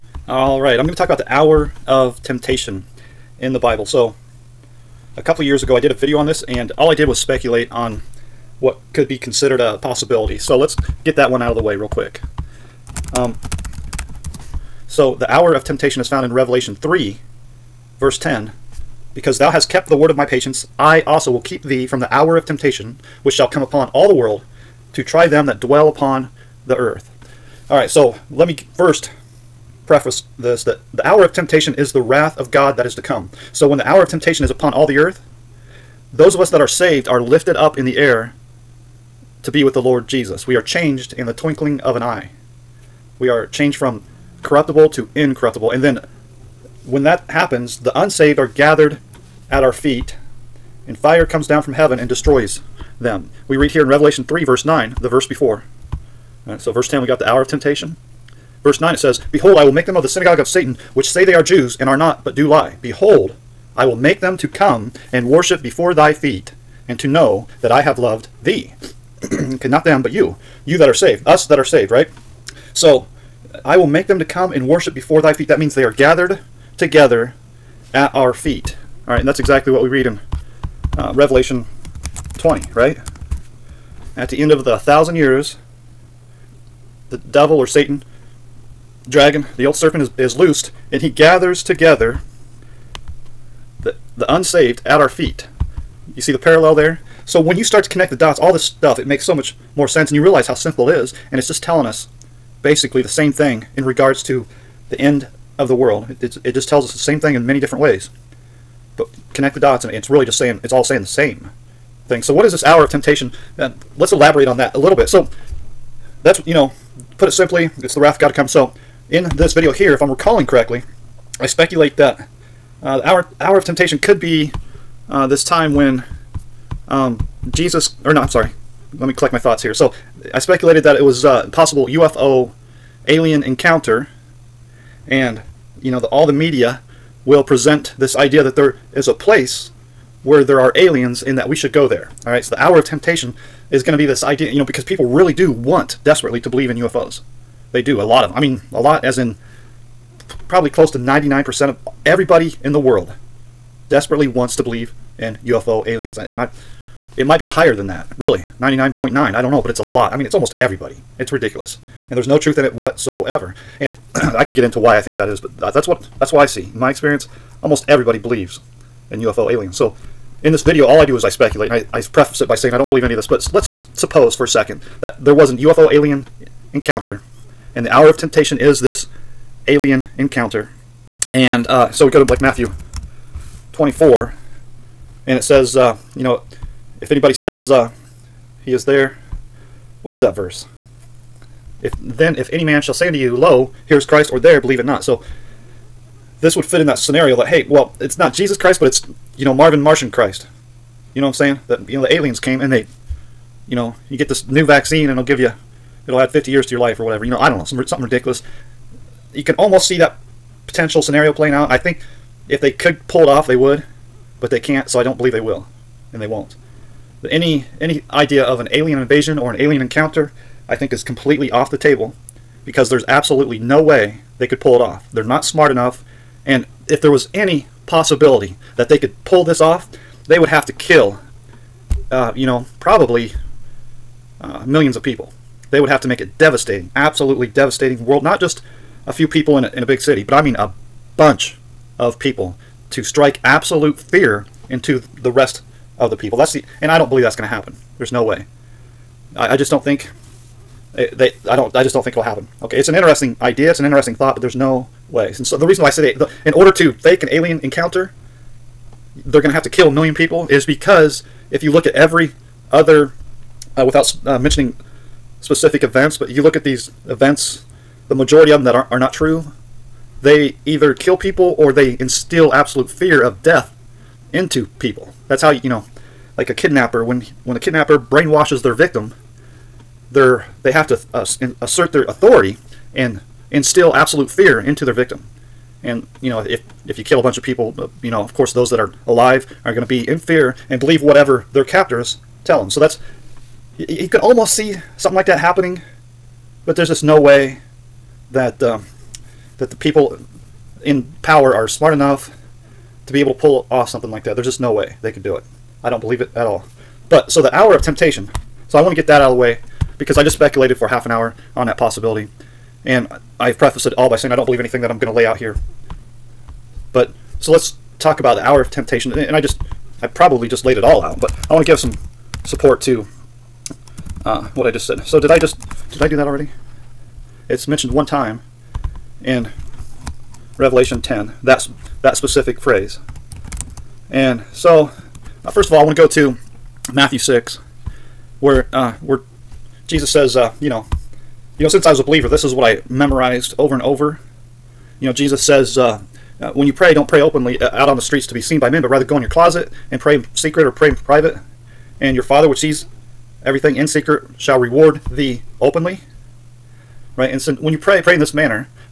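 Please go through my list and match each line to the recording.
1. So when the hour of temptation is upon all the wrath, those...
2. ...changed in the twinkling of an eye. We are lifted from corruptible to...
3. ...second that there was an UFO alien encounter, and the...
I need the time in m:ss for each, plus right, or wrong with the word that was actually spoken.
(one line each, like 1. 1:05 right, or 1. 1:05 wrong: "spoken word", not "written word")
1. 0:33 wrong: "earth", not "wrath"
2. 0:40 wrong: "changed", not "lifted"
3. 2:54 right.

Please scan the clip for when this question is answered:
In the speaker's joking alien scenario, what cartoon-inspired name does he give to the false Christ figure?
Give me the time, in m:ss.
3:19.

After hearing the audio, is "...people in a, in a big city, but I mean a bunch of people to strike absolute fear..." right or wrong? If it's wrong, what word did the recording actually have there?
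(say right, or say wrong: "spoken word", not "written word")
right.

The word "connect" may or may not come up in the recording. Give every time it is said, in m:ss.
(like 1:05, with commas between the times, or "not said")
1:37, 1:49.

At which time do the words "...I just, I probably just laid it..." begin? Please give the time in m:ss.
5:19.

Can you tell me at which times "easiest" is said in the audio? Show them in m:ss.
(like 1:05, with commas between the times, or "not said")
not said.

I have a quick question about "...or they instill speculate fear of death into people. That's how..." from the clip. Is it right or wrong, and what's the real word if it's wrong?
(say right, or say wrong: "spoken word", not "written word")
wrong: "absolute", not "speculate".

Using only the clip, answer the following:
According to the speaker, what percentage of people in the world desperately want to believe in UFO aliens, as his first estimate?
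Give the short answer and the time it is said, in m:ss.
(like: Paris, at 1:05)
99%, at 2:30.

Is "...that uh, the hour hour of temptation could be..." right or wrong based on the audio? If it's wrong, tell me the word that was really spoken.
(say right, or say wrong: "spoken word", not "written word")
right.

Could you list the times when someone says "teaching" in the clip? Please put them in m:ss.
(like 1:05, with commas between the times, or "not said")
not said.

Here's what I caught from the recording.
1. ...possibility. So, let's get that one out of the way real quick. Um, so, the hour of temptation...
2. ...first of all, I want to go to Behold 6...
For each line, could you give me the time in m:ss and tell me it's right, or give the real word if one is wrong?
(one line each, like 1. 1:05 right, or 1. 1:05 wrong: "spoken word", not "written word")
1. 0:09 right
2. 5:35 wrong: "Matthew", not "Behold".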